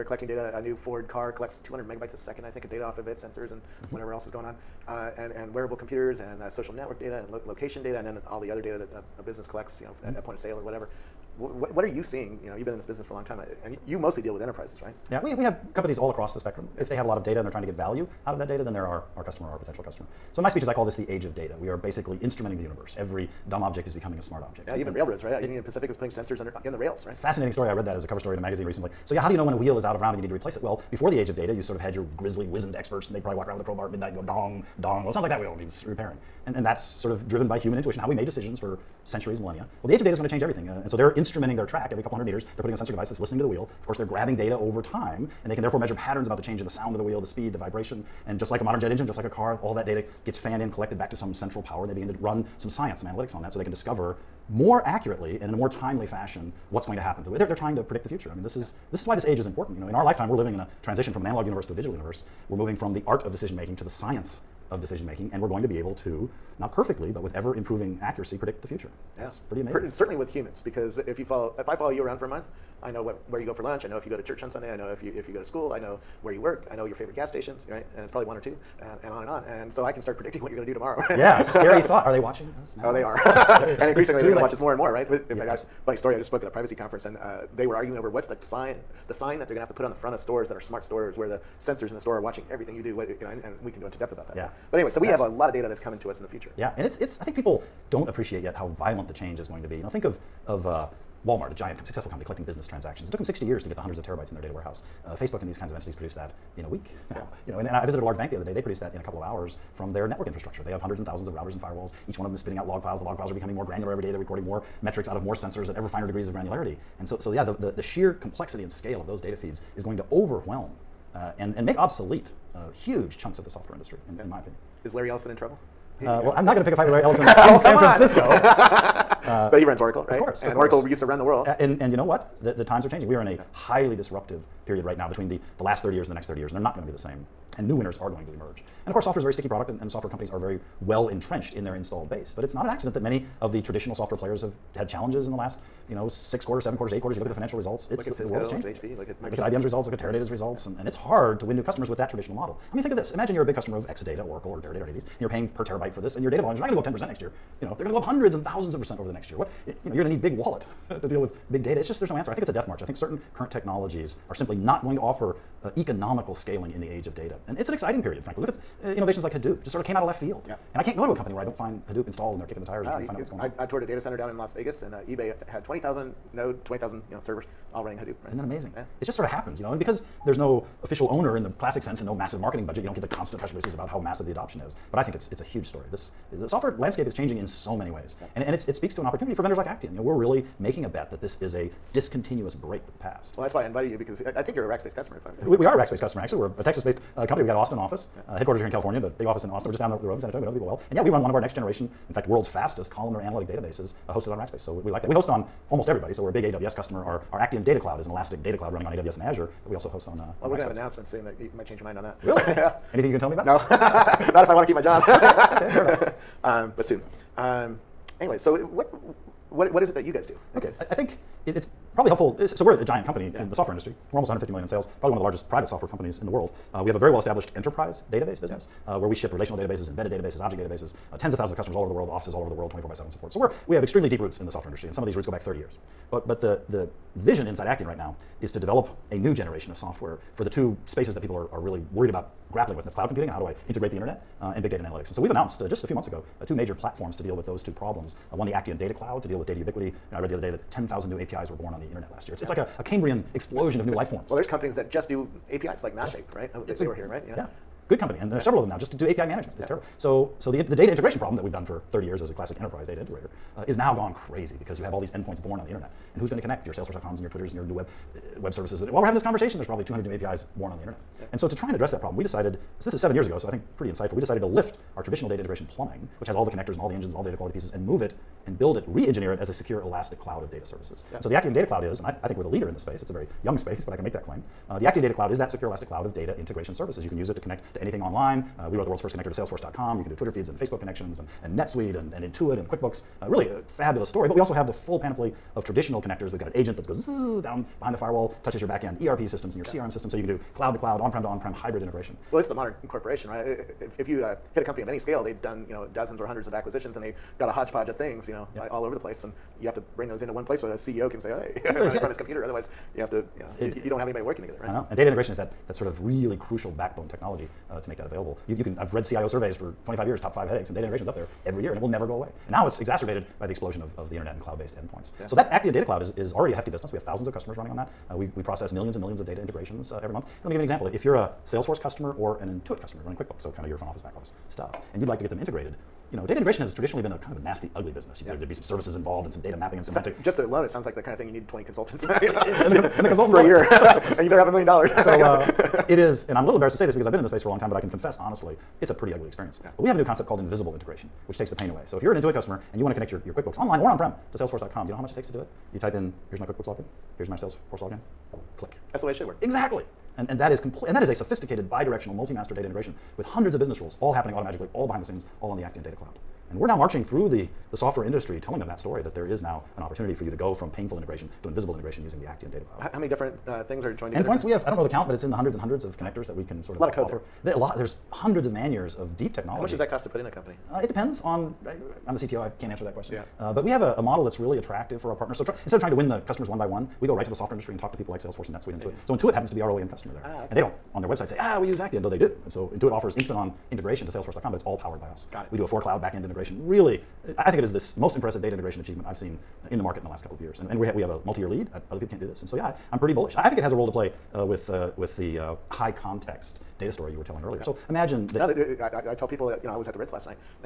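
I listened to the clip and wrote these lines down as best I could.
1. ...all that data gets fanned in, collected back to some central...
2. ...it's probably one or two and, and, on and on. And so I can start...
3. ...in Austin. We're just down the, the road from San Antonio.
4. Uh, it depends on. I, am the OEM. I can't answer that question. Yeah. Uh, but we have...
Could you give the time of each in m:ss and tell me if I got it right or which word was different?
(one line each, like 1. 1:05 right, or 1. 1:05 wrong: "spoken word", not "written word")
1. 0:49 right
2. 1:18 right
3. 3:19 right
4. 6:20 wrong: "CTO", not "OEM".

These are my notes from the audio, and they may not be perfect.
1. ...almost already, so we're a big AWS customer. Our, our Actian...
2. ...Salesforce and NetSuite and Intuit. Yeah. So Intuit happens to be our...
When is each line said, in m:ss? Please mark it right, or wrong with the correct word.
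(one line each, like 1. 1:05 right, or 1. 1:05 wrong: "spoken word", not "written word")
1. 3:25 wrong: "everybody", not "already"
2. 6:28 right.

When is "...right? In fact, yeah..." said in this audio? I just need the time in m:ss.
1:24.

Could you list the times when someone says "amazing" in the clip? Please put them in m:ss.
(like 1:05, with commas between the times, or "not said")
1:09, 2:58.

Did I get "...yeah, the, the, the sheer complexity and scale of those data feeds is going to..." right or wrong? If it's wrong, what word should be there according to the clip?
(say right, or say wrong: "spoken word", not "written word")
right.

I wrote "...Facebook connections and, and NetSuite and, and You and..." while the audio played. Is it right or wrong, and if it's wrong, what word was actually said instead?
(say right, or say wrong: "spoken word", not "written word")
wrong: "Intuit", not "You".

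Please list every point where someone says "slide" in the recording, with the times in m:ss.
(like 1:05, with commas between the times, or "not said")
not said.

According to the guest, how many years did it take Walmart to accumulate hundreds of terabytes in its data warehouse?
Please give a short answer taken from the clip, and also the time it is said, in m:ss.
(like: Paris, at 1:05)
60, at 1:43.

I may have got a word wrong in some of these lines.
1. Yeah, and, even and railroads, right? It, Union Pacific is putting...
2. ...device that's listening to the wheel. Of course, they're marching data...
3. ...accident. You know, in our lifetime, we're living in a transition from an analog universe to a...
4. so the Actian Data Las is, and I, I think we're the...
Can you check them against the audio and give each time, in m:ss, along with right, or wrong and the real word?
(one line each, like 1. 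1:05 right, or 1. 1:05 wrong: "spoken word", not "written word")
1. 0:24 right
2. 0:42 wrong: "grabbing", not "marching"
3. 0:59 wrong: "important", not "accident"
4. 4:41 wrong: "Cloud", not "Las".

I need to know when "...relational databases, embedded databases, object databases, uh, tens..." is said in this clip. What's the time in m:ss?
3:49.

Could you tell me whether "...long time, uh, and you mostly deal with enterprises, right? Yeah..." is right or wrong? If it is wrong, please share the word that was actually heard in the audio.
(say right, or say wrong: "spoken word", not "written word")
right.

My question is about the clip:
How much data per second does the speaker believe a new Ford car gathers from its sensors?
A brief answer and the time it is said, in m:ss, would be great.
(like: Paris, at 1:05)
200 megabytes, at 0:01.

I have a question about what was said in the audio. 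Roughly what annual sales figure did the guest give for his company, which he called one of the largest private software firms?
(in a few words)
150 million.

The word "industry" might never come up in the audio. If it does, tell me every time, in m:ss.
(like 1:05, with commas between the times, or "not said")
2:03, 3:43, 3:54, 6:08, 6:27.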